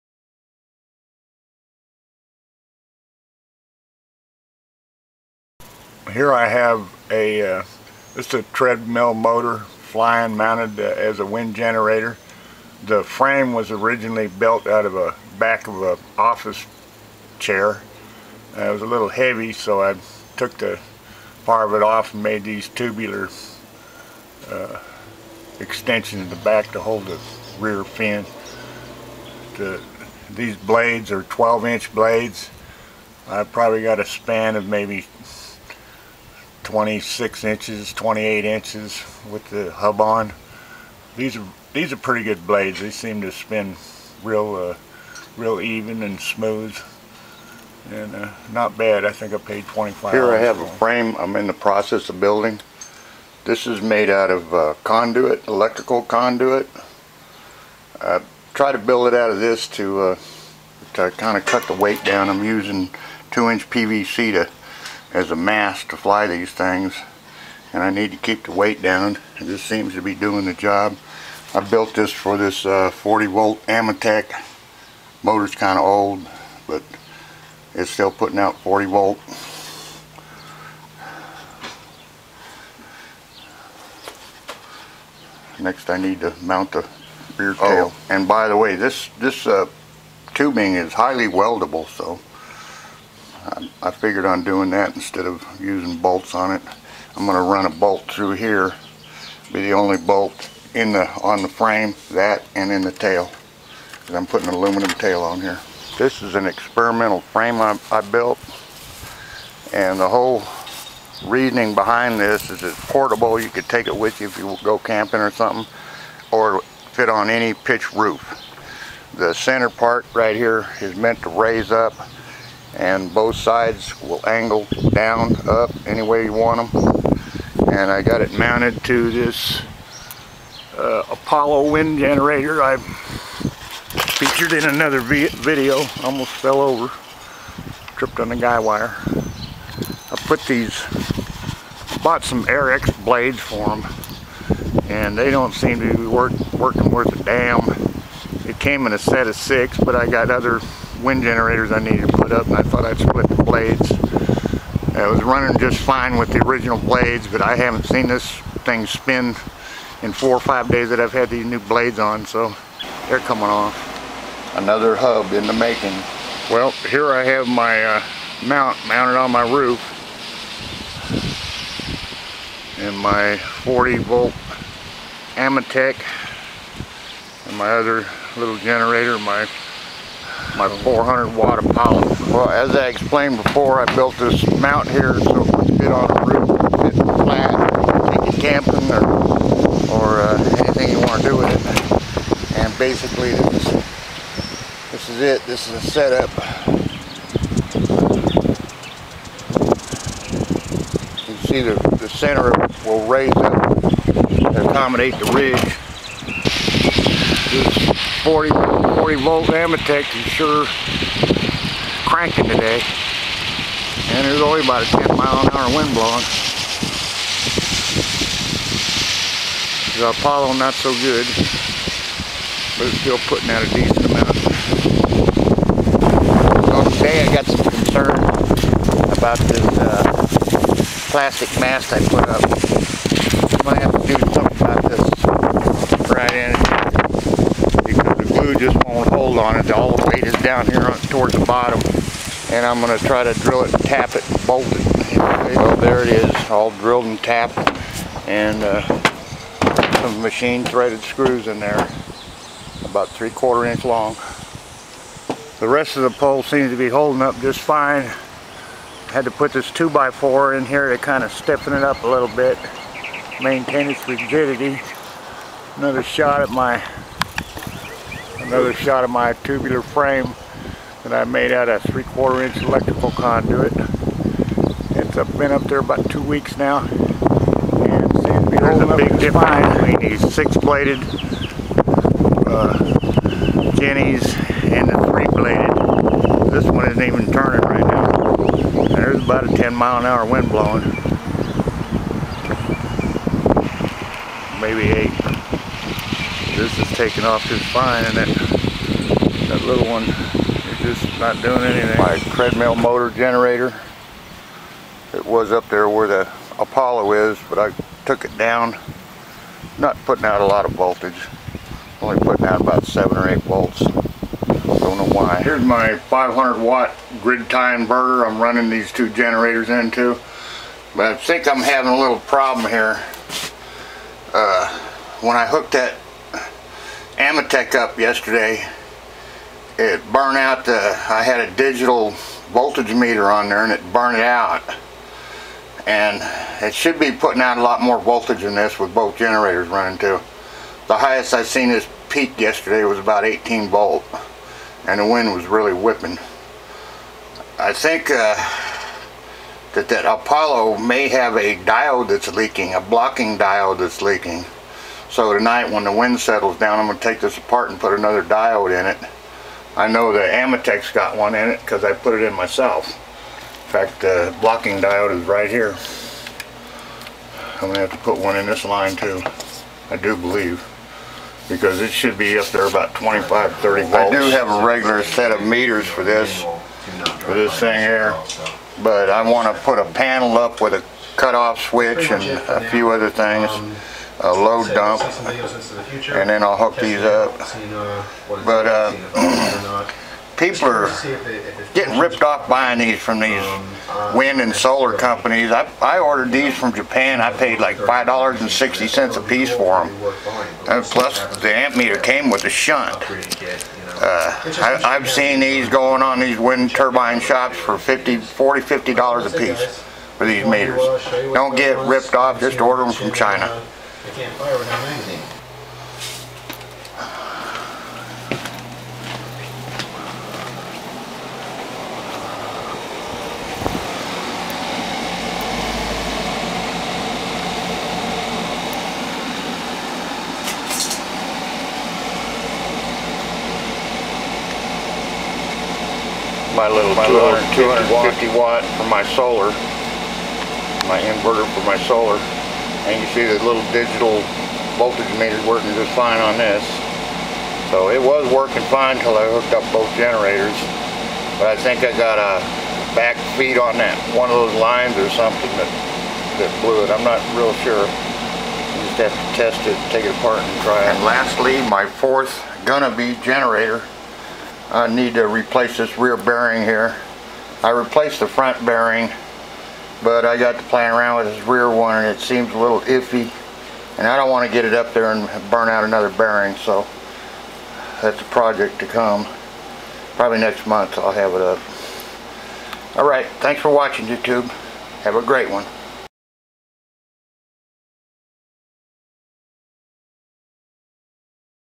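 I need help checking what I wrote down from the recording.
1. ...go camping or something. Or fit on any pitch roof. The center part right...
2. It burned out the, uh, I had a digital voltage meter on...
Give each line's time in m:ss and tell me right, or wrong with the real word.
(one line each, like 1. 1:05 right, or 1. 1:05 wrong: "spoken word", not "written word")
1. 1:54 right
2. 5:29 right.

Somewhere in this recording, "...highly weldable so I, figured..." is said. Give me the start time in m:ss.
1:30.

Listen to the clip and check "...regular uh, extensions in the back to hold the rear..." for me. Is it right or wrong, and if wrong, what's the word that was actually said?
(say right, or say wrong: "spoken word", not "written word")
wrong: "tubular", not "regular".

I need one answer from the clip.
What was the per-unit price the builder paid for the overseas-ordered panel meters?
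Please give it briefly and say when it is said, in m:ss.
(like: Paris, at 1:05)
$5.60, at 6:37.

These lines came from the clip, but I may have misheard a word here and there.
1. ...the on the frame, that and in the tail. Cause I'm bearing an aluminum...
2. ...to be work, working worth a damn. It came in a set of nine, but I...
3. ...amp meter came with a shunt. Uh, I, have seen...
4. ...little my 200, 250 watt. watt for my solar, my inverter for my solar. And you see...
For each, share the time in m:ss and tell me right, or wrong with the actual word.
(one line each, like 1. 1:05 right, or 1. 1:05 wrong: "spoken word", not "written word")
1. 1:40 wrong: "putting", not "bearing"
2. 2:25 wrong: "six", not "nine"
3. 6:41 right
4. 7:16 right.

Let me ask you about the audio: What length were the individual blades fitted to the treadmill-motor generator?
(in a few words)
12 inch.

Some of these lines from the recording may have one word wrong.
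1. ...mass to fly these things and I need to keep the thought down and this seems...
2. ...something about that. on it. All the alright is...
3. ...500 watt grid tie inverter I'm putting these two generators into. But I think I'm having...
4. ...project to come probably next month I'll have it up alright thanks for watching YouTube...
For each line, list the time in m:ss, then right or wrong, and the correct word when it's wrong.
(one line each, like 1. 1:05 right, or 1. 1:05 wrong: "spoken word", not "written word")
1. 1:05 wrong: "weight", not "thought"
2. 3:54 wrong: "weight", not "alright"
3. 5:15 wrong: "running", not "putting"
4. 7:58 right.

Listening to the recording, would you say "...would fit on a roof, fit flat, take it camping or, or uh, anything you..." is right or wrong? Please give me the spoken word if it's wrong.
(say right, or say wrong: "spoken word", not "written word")
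right.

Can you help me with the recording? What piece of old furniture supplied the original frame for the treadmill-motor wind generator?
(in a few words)
office chair.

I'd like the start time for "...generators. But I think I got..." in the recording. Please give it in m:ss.
7:29.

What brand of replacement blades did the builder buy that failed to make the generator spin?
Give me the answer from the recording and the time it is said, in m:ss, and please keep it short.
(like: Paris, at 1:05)
Airx, at 2:22.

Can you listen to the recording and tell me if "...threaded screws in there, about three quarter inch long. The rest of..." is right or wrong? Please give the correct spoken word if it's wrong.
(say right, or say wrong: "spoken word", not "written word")
right.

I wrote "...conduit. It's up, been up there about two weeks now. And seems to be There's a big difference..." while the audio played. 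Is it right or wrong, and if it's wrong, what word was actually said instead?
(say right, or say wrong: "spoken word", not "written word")
right.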